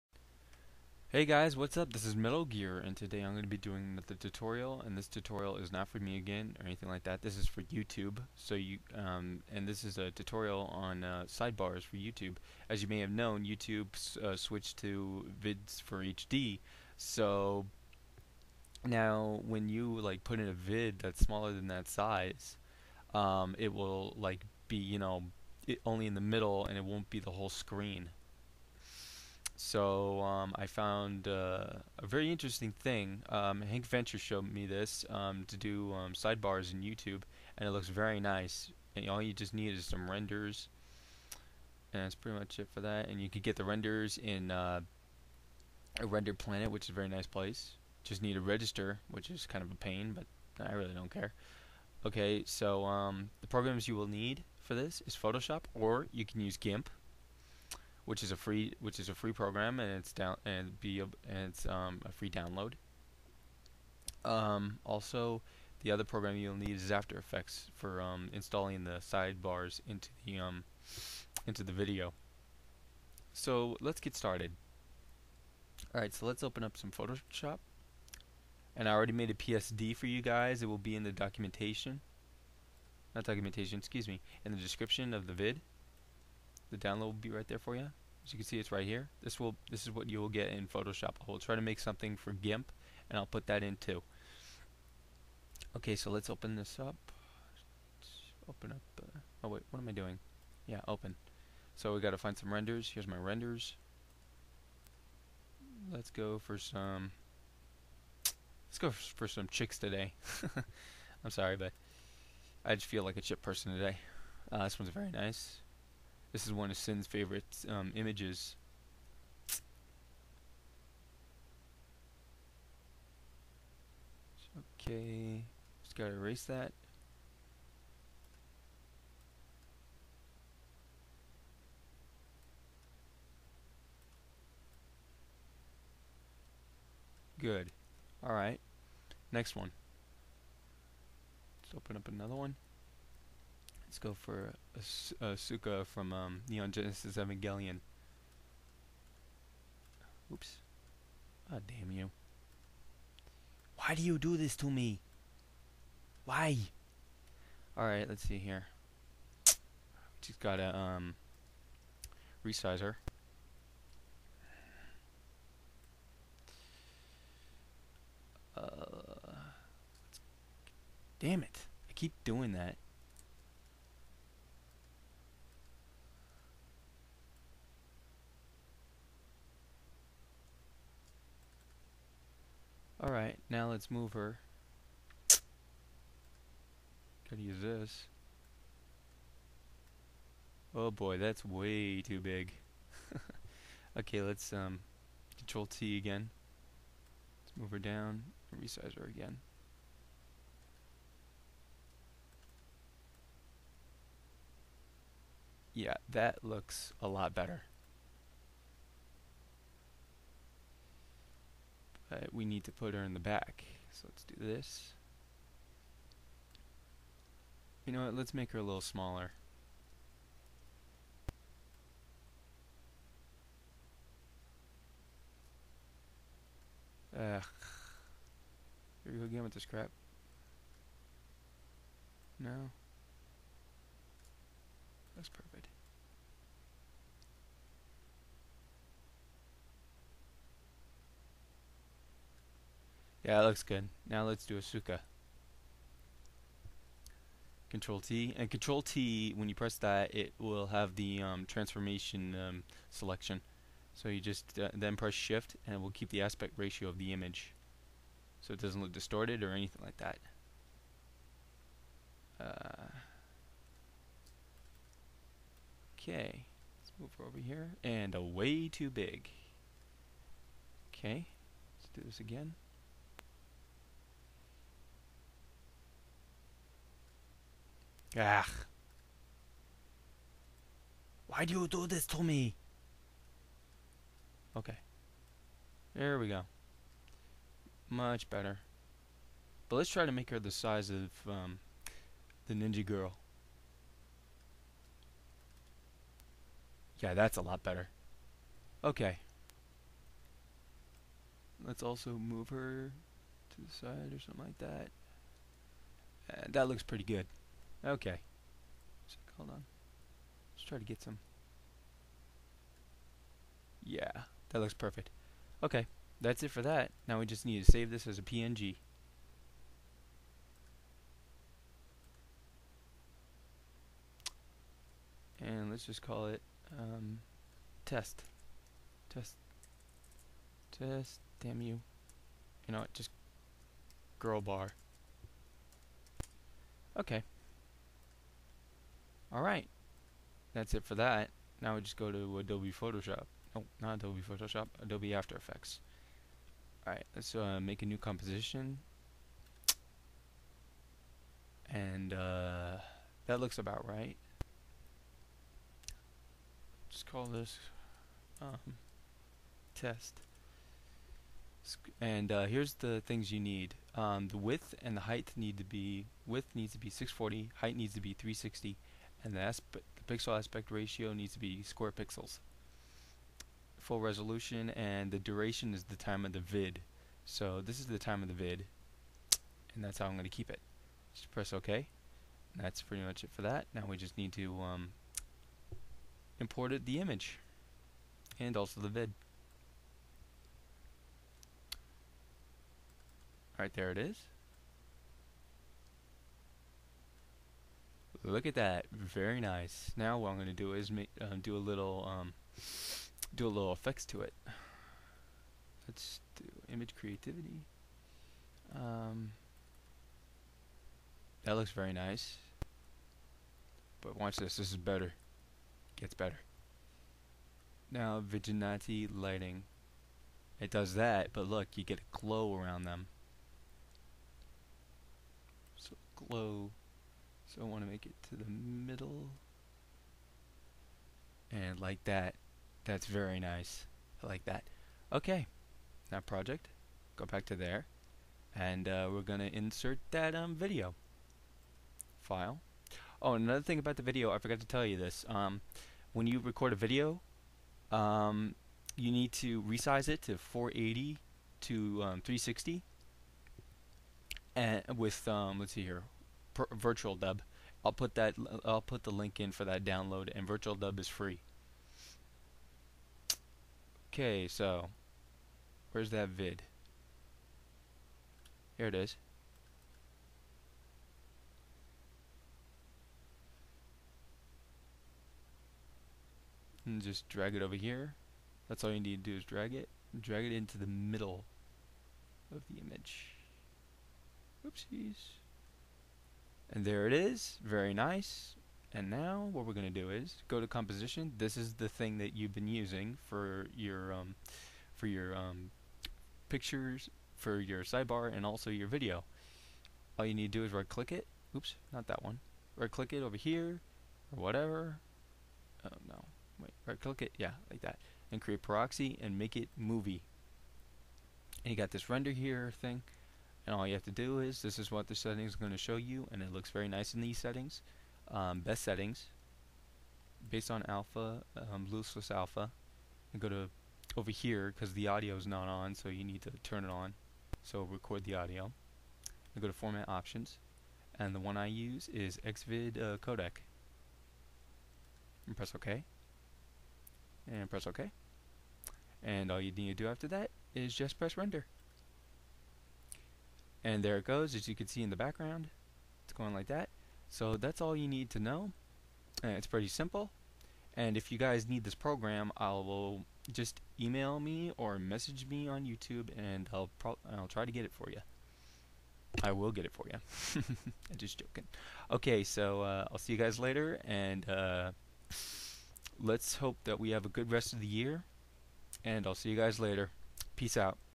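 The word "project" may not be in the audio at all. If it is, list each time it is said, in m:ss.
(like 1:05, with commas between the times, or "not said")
7:16.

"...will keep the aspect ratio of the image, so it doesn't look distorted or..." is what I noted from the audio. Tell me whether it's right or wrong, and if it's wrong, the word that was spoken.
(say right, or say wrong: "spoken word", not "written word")
right.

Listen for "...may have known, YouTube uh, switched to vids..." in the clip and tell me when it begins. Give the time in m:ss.
0:12.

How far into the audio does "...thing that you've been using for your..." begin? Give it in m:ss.
8:11.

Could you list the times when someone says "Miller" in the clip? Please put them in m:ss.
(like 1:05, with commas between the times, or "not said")
not said.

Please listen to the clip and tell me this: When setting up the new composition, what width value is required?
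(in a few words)
640.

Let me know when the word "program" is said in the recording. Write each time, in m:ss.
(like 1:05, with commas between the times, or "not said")
0:53, 0:59, 1:06, 9:11.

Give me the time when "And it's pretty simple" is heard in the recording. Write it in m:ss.
9:09.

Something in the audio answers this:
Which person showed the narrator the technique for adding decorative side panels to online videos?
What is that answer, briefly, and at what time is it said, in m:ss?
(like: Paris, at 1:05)
Hank Venture, at 0:33.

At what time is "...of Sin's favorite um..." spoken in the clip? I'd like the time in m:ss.
1:56.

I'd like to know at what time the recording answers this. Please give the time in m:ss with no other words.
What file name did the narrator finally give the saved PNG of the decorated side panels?
5:34.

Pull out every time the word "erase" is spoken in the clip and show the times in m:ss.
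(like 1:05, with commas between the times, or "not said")
2:06.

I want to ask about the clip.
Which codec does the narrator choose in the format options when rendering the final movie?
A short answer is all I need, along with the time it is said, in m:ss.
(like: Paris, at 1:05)
Xvid, at 8:52.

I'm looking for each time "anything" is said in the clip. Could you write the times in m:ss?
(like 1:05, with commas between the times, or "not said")
0:06, 4:19.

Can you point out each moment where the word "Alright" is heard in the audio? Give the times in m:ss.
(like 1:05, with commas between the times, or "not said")
1:15, 2:18, 2:37, 3:03, 5:39, 5:46, 6:33.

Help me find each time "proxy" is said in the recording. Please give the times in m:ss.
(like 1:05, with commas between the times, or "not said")
8:28.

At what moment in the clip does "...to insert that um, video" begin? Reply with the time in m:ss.
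7:19.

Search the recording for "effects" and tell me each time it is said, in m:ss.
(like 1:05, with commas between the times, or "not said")
1:07, 5:45, 6:43.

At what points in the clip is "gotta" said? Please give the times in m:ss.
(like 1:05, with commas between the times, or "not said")
2:05, 2:40, 3:07.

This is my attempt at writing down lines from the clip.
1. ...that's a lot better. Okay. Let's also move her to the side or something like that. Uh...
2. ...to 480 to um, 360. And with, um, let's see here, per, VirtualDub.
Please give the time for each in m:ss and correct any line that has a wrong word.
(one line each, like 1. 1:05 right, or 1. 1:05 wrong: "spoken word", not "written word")
1. 4:57 right
2. 7:30 right.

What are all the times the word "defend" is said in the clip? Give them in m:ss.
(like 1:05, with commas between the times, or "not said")
not said.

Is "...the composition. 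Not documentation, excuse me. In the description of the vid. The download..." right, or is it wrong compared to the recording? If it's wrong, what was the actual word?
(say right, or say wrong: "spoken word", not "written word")
wrong: "documentation", not "composition".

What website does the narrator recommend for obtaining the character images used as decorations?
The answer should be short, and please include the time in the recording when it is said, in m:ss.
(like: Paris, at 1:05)
Render planet, at 0:46.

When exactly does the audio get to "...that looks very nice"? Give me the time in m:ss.
6:51.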